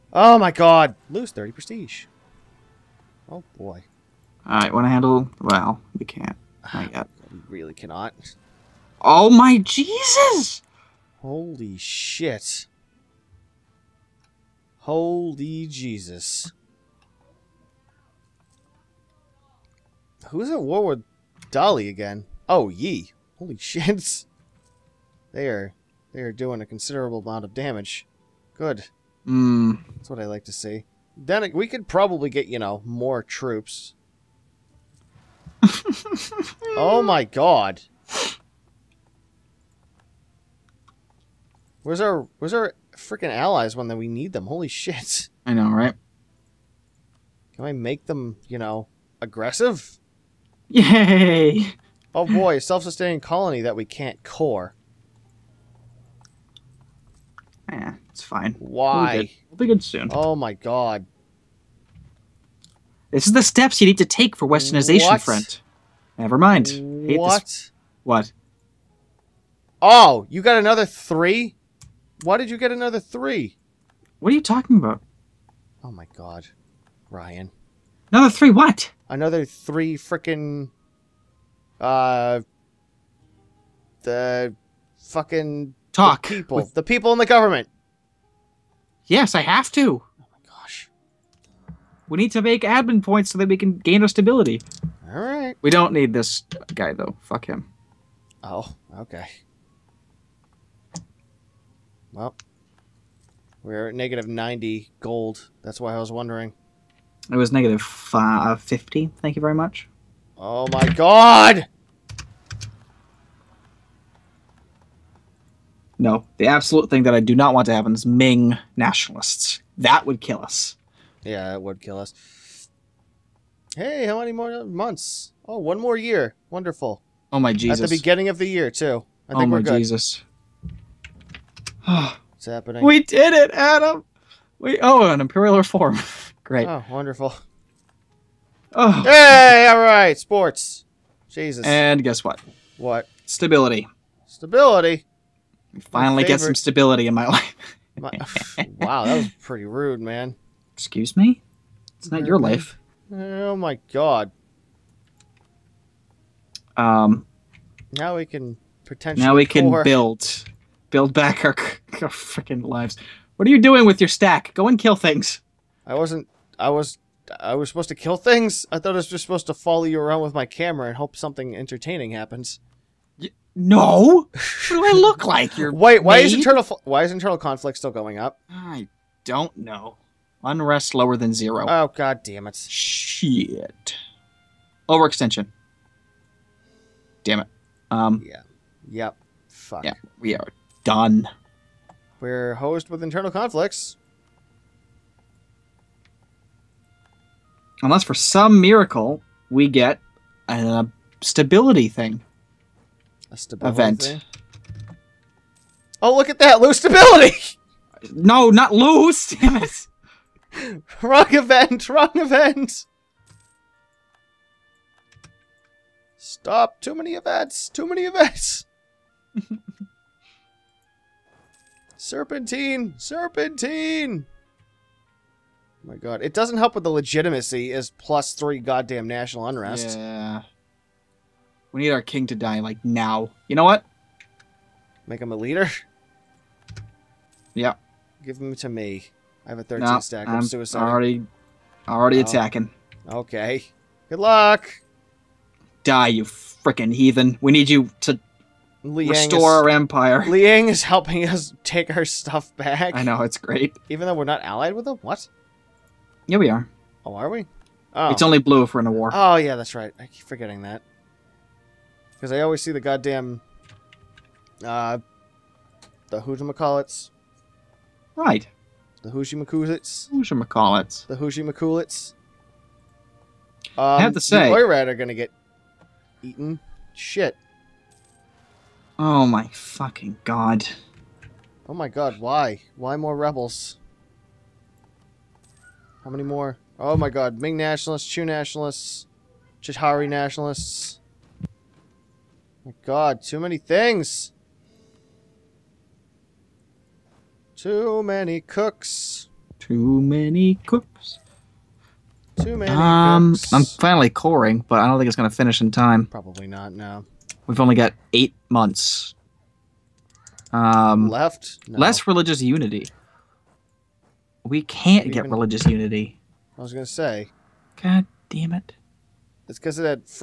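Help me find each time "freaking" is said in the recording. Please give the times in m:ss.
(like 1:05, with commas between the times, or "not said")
0:42, 2:42, 4:06.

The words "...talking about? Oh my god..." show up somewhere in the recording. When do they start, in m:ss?
1:14.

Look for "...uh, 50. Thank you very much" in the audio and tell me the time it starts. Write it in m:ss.
1:48.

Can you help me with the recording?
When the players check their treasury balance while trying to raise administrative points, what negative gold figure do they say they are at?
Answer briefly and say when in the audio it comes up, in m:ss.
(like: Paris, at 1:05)
-90, at 1:43.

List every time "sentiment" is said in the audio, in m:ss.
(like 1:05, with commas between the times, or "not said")
not said.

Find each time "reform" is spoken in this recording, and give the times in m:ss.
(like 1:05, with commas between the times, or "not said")
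2:15.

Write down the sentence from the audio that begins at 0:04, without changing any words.
Alright, wanna handle well, we can't.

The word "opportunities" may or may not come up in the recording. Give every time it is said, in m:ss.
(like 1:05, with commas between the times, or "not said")
not said.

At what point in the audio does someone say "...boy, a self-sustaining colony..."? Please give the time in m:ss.
0:52.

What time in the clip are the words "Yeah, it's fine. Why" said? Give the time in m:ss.
0:57.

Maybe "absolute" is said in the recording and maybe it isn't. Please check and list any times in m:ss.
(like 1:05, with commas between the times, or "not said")
1:56.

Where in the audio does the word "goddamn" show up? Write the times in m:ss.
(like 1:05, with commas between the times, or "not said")
3:48, 4:22.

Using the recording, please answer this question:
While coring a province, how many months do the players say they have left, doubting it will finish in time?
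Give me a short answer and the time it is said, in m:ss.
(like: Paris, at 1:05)
8, at 5:08.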